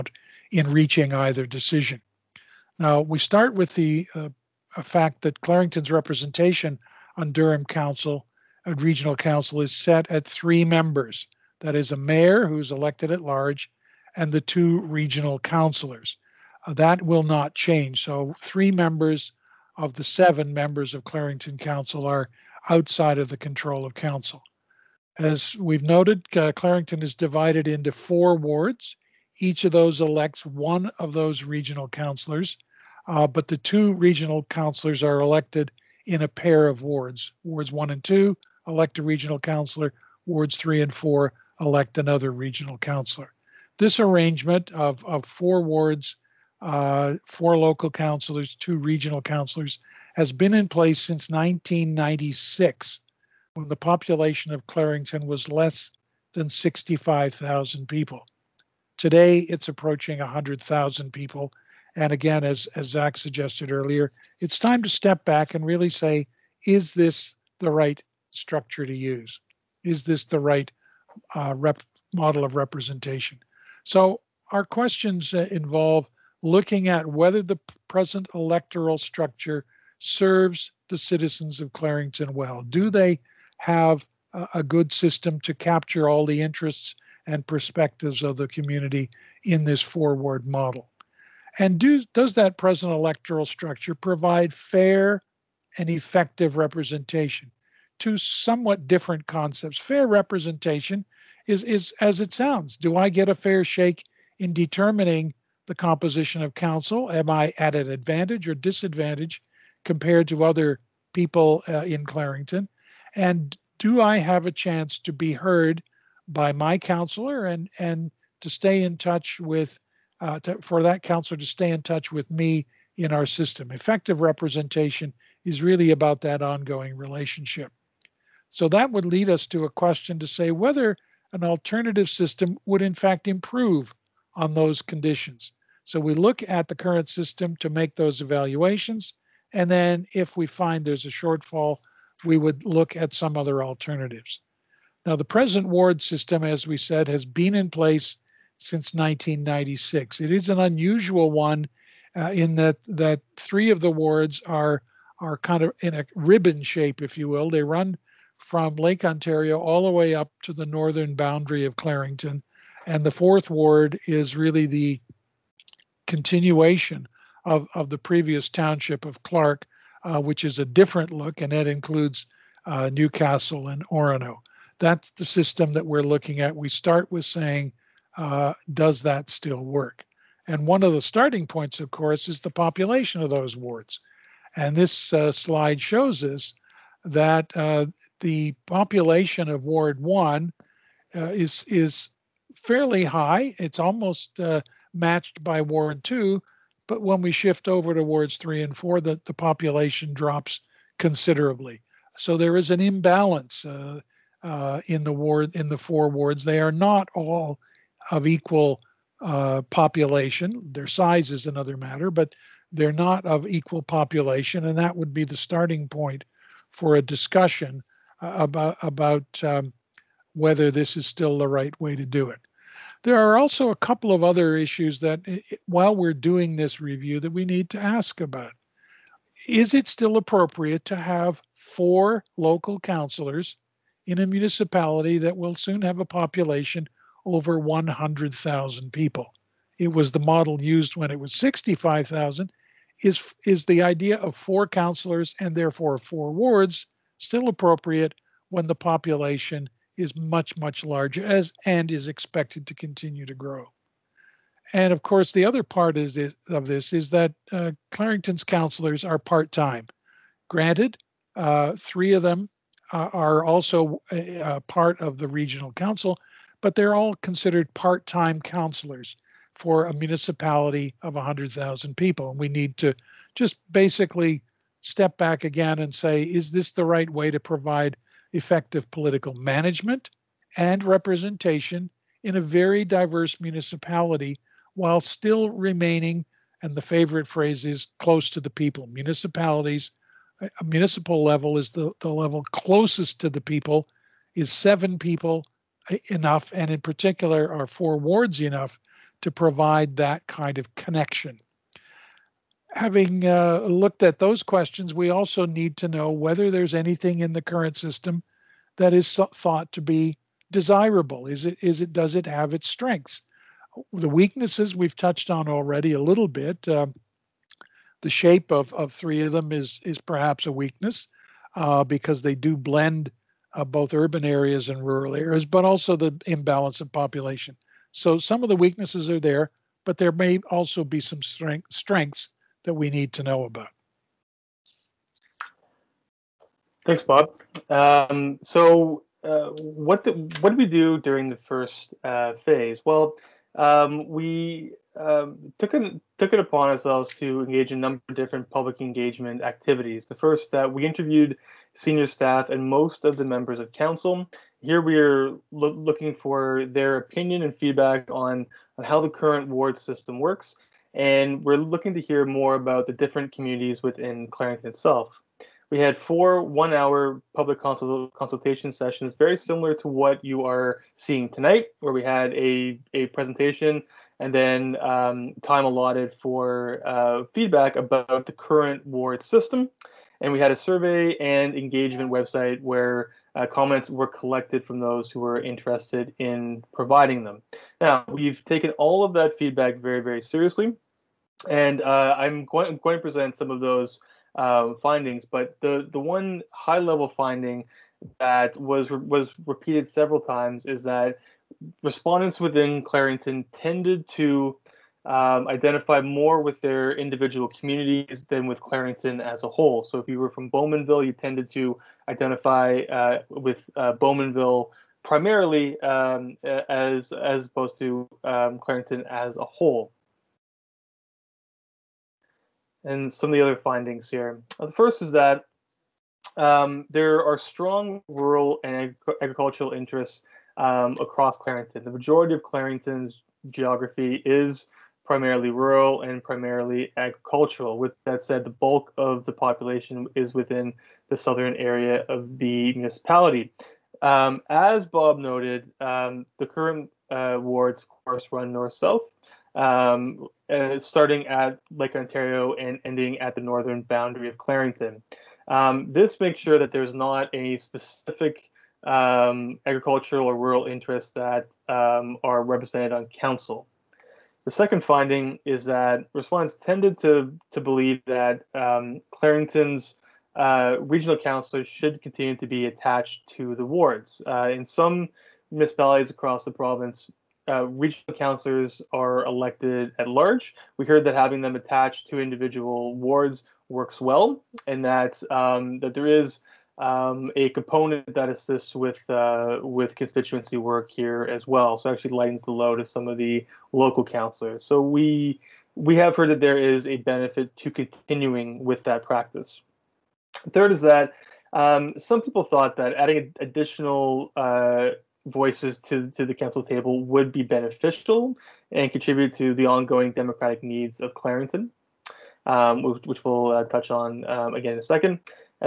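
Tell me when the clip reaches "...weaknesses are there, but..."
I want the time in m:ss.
5:28.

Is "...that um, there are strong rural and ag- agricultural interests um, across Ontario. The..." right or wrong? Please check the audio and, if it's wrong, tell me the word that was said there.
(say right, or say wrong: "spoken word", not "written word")
wrong: "Clarington", not "Ontario".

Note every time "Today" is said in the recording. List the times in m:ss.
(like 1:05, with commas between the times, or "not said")
0:58.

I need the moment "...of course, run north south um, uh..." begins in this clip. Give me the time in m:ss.
7:27.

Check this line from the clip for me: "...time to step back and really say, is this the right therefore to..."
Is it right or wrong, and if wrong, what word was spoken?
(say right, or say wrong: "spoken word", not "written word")
wrong: "structure", not "therefore".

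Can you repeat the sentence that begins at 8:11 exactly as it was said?
So actually lightens the load of some of the local councillors.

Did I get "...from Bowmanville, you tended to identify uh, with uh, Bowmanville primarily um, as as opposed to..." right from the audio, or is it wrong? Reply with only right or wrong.
right.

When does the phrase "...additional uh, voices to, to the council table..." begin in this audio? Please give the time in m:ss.
8:23.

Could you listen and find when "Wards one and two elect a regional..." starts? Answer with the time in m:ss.
0:37.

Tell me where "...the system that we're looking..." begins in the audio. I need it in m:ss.
2:55.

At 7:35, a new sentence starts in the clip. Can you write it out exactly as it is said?
Um, this makes sure that there's not any specific um, agricultural or rural interests that um, are represented on council.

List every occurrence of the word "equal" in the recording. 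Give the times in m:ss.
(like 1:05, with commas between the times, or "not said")
3:28, 3:33.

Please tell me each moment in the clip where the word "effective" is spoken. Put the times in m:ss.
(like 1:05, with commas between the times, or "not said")
1:35, 2:03, 4:38.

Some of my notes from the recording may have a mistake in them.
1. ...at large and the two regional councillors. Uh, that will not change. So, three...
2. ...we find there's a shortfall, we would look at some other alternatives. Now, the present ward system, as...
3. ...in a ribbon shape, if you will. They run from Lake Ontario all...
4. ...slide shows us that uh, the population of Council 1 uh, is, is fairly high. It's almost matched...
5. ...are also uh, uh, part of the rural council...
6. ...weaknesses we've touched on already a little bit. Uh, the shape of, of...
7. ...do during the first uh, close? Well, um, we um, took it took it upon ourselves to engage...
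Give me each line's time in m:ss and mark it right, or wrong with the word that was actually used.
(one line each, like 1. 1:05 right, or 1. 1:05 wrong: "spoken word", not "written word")
1. 0:13 right
2. 2:20 right
3. 2:35 right
4. 3:05 wrong: "Ward", not "Council"
5. 4:23 wrong: "regional", not "rural"
6. 5:14 right
7. 5:40 wrong: "phase", not "close".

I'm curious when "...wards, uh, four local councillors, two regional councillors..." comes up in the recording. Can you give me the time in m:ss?
0:45.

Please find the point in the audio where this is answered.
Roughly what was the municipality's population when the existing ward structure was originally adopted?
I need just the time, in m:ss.
0:55.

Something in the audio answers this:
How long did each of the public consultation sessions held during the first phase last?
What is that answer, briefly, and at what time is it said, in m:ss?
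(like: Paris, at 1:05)
1 hour, at 6:06.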